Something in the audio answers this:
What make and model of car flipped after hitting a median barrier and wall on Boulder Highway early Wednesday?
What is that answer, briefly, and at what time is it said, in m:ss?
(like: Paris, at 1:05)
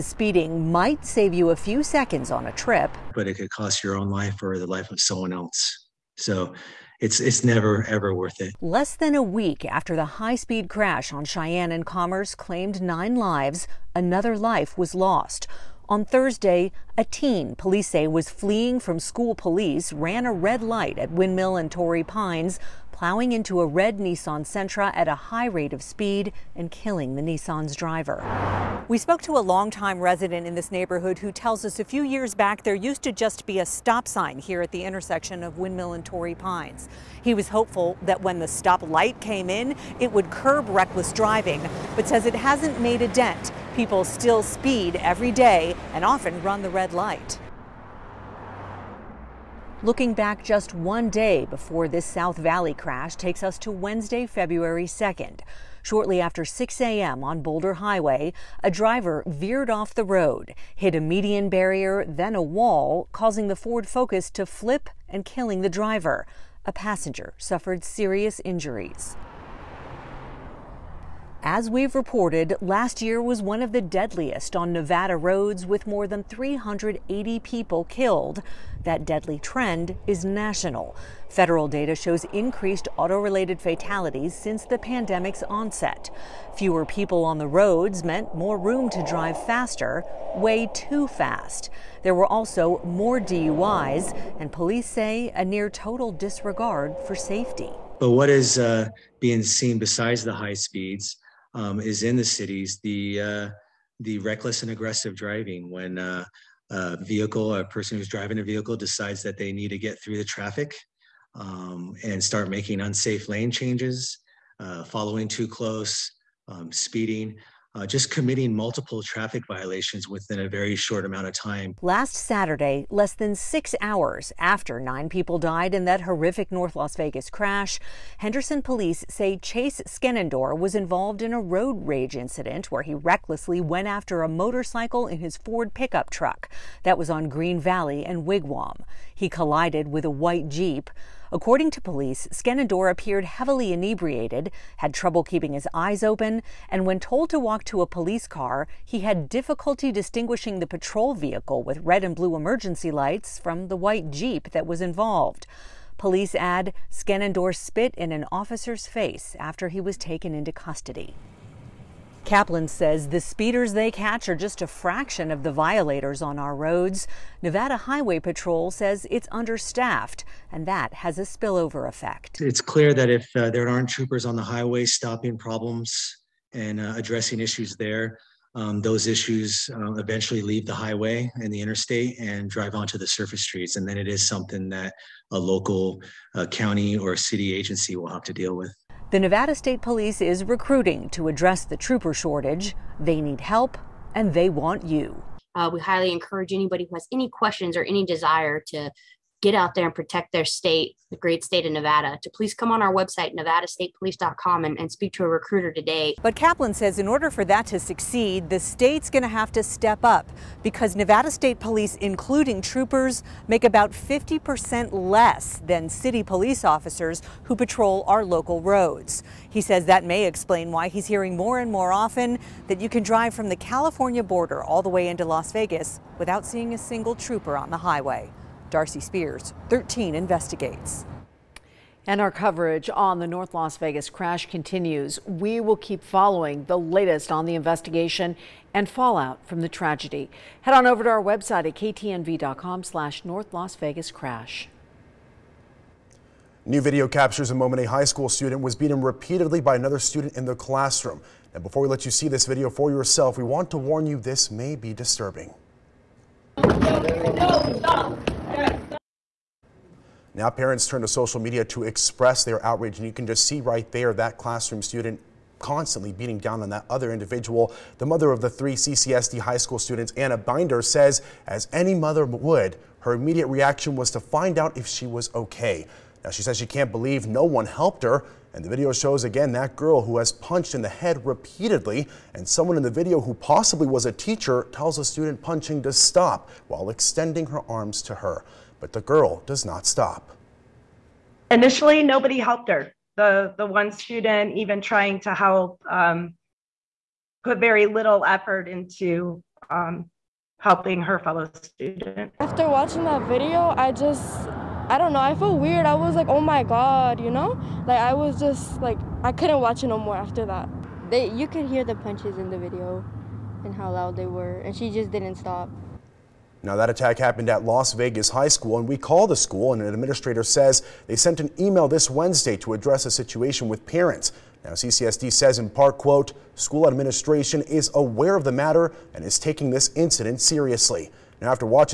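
Ford Focus, at 1:03.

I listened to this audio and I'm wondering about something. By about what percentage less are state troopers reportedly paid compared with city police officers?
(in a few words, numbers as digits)
50%.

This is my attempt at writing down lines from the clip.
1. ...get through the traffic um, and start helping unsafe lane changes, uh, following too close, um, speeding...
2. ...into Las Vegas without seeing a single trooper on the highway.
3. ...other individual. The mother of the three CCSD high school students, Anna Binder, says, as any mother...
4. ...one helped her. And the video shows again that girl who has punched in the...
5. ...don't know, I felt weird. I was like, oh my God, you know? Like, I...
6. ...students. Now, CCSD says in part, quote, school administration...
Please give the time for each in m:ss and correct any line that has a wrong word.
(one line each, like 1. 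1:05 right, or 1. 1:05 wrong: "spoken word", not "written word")
1. 1:49 wrong: "making", not "helping"
2. 3:45 right
3. 4:26 right
4. 4:37 right
5. 5:04 right
6. 5:23 wrong: "parents", not "students".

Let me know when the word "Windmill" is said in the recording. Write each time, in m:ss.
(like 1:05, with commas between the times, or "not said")
0:21, 0:35.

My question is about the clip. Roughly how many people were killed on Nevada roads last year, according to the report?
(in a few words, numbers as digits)
More than 380.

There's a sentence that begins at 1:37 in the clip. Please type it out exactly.
But what is uh, being seen besides the high speeds?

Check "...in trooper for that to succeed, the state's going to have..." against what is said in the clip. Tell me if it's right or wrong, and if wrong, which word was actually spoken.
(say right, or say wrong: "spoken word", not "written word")
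wrong: "order", not "trooper".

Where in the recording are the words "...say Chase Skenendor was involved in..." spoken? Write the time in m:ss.
2:09.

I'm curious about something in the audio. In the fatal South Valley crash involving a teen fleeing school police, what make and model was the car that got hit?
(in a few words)
Nissan Sentra.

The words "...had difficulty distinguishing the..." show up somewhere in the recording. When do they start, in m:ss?
2:29.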